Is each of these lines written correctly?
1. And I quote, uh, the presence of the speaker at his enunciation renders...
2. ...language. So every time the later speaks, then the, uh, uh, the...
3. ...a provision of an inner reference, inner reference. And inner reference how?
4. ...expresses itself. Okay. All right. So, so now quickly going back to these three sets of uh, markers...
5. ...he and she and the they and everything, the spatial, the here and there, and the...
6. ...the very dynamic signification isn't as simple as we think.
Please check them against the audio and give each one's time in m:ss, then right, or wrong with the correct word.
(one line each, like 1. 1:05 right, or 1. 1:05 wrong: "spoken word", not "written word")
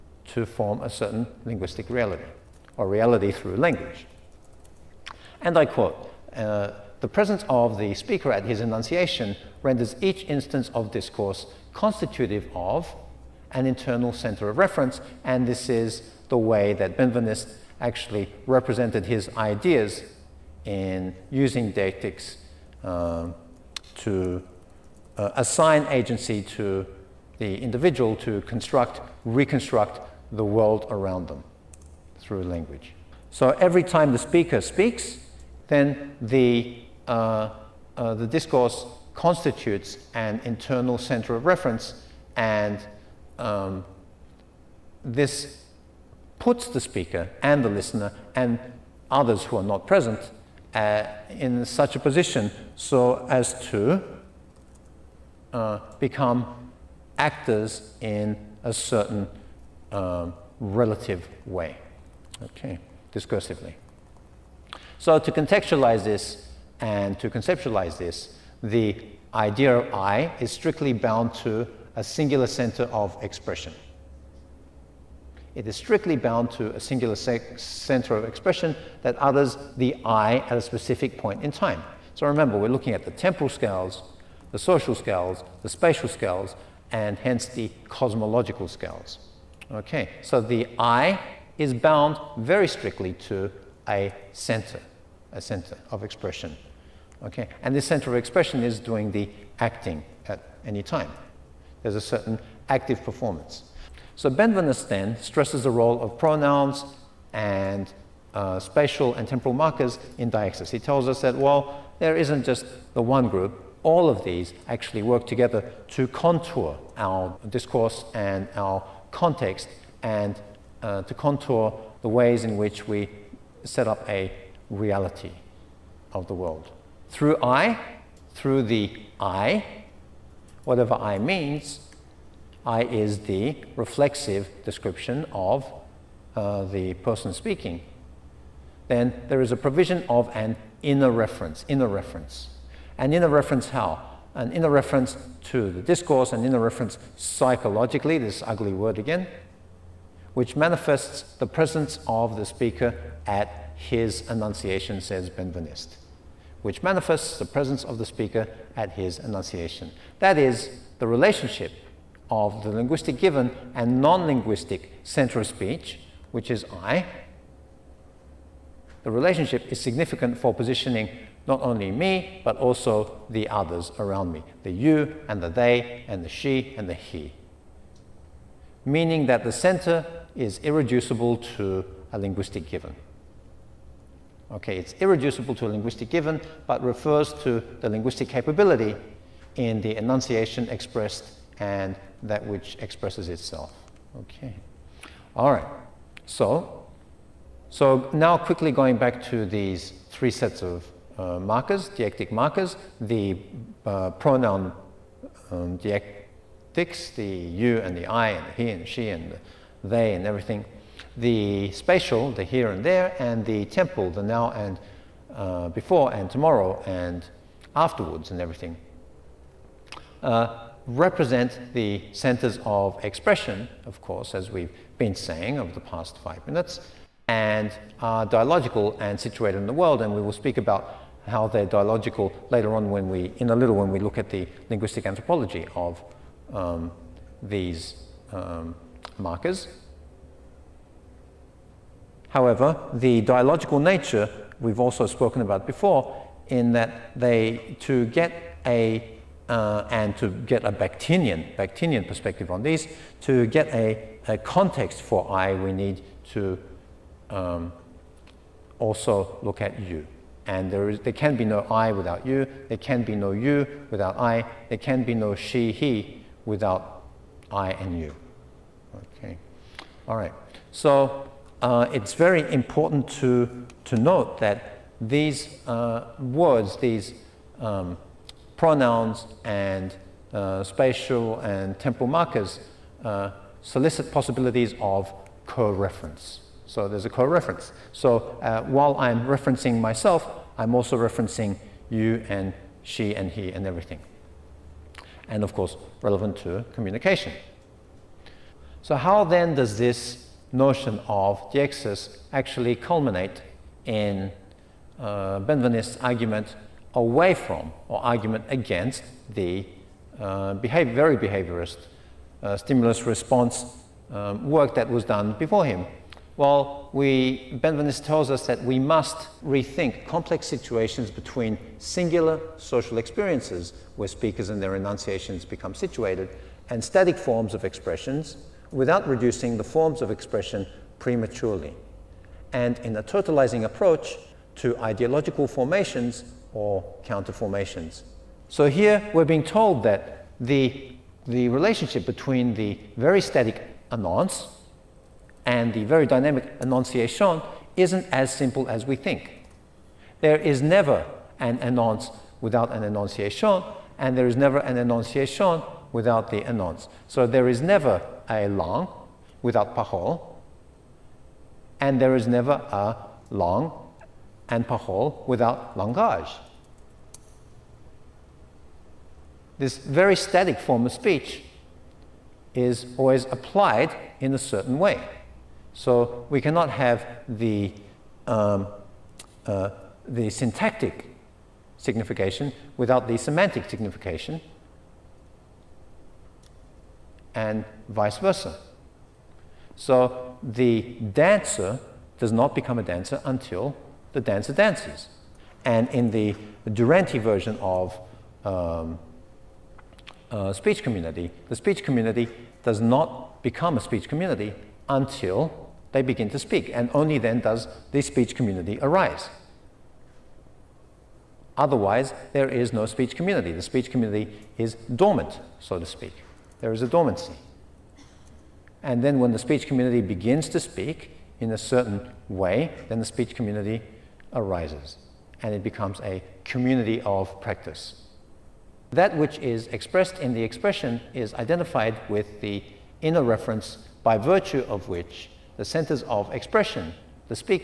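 1. 0:05 right
2. 0:32 wrong: "speaker", not "later"
3. 2:19 right
4. 3:12 right
5. 3:28 right
6. 5:45 wrong: "enunciation", not "signification".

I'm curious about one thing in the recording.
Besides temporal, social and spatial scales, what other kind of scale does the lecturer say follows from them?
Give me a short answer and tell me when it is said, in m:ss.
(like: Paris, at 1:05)
cosmological, at 1:27.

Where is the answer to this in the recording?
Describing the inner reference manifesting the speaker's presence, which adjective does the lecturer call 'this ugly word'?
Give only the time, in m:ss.
2:27.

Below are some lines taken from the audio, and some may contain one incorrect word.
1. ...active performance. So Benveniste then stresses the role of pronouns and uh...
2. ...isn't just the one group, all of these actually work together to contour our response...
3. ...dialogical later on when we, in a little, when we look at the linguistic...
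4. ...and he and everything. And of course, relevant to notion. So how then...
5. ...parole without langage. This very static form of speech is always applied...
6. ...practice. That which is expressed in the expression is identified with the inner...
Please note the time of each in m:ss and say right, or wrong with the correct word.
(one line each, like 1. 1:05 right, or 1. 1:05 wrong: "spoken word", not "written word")
1. 1:42 right
2. 1:52 wrong: "discourse", not "response"
3. 3:51 right
4. 4:53 wrong: "communication", not "notion"
5. 6:04 right
6. 7:07 right.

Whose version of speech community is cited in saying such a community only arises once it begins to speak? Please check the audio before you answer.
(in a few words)
Duranti.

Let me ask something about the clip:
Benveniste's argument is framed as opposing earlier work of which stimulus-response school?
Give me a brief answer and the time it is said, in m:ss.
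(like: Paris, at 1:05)
behaviorist, at 5:11.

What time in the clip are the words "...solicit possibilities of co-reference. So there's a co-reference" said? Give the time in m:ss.
4:43.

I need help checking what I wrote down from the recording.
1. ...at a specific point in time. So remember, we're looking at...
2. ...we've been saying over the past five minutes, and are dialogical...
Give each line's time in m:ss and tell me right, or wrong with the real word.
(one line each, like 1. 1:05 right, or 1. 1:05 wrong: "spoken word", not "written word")
1. 1:20 right
2. 3:44 right.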